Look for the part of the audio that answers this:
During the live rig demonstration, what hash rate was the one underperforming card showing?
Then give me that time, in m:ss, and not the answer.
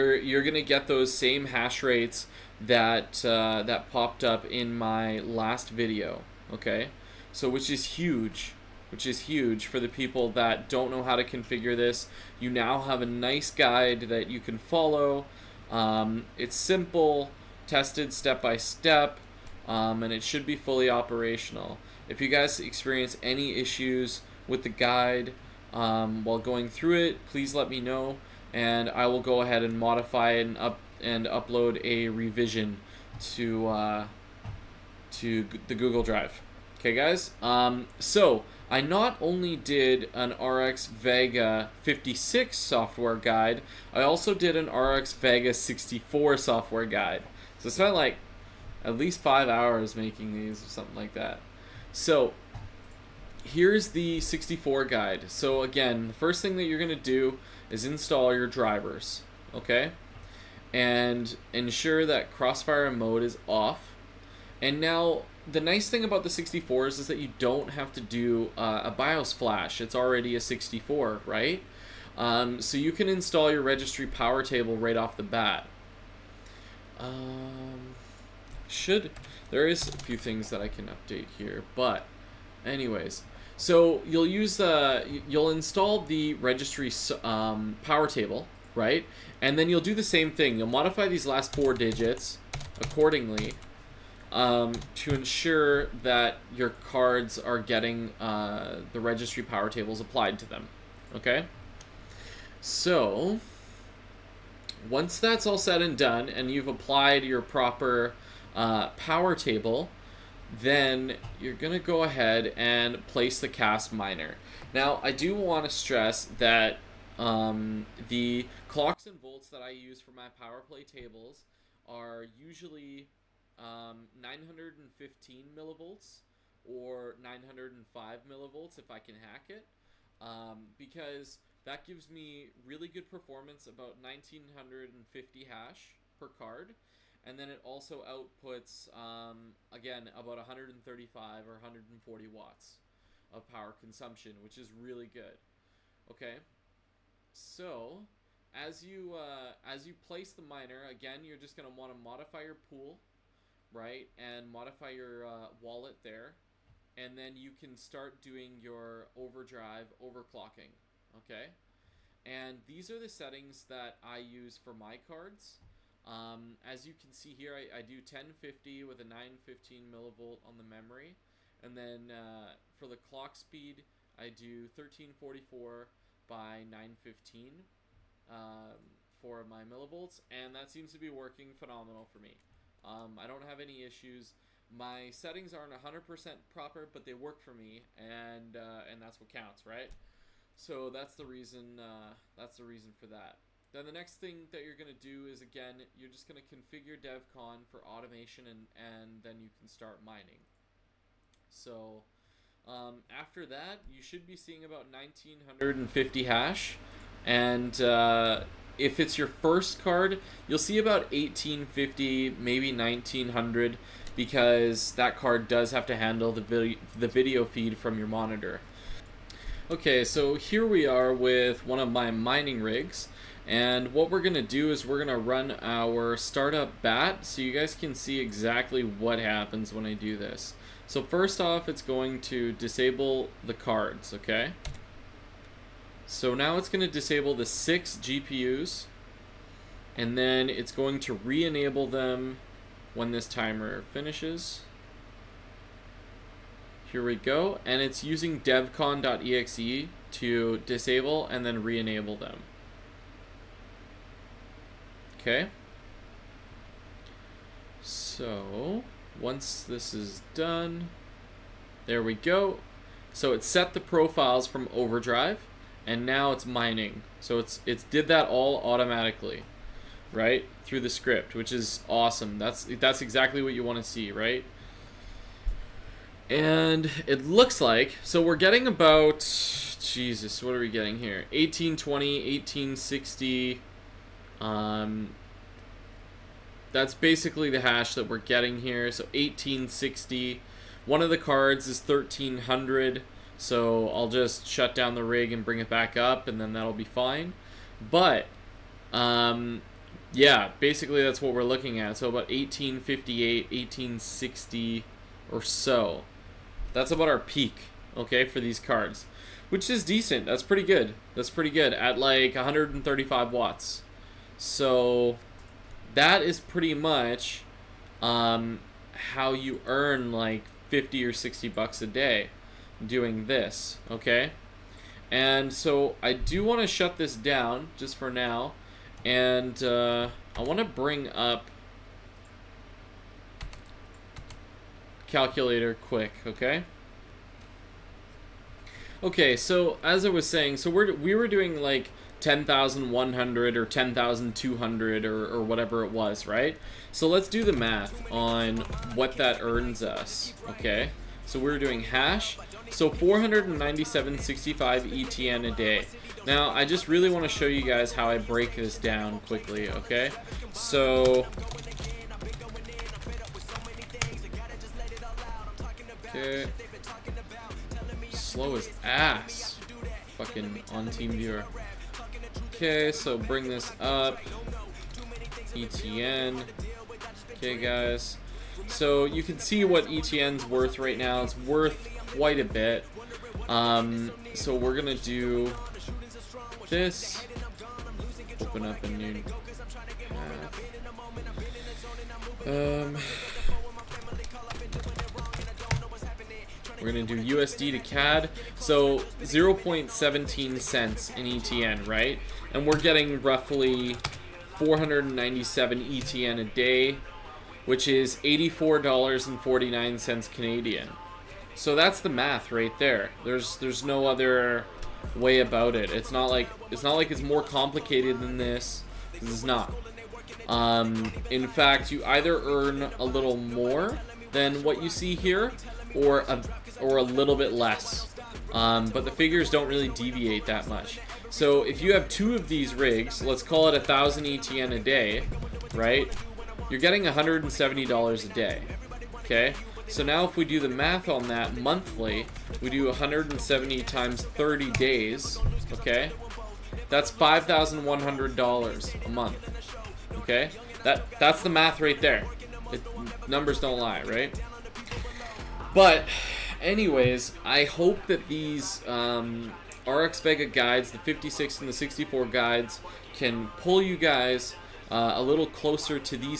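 4:51.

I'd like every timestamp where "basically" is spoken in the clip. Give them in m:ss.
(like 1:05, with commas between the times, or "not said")
4:46, 5:00.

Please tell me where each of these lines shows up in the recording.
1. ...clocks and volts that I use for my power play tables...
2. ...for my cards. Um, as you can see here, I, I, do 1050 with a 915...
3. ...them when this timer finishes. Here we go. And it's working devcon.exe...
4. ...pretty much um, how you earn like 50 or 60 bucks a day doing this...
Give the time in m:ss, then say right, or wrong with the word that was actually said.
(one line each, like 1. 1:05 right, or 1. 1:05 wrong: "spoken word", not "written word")
1. 1:58 right
2. 2:44 right
3. 4:01 wrong: "using", not "working"
4. 5:16 right.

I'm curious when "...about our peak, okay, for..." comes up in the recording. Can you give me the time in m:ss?
5:06.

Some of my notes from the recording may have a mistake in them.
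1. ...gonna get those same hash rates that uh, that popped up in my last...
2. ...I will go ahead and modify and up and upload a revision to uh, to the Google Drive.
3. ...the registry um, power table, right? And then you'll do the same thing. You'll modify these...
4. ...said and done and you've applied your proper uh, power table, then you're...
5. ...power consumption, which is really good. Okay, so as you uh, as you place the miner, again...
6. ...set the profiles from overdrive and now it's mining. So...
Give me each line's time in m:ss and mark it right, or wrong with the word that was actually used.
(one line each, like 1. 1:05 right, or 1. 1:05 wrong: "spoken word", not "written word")
1. 0:00 right
2. 0:28 right
3. 1:26 right
4. 1:45 right
5. 2:23 right
6. 4:23 right.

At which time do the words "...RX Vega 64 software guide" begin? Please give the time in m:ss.
0:44.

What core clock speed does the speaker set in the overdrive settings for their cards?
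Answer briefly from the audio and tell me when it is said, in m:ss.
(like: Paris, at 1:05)
1344, at 2:54.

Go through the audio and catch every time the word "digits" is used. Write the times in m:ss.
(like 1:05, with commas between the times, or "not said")
1:31.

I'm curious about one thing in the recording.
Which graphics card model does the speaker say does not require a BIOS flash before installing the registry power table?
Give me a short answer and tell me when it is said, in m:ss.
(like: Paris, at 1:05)
RX Vega 64, at 1:06.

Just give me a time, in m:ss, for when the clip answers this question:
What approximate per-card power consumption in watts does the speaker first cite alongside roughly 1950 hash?
2:20.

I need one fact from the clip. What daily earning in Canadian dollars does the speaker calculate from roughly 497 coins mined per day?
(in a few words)
$84.49.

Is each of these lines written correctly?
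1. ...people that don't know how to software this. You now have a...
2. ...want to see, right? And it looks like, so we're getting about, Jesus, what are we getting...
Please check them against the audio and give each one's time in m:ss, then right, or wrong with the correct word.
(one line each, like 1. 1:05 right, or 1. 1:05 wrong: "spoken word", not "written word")
1. 0:09 wrong: "configure", not "software"
2. 4:33 right.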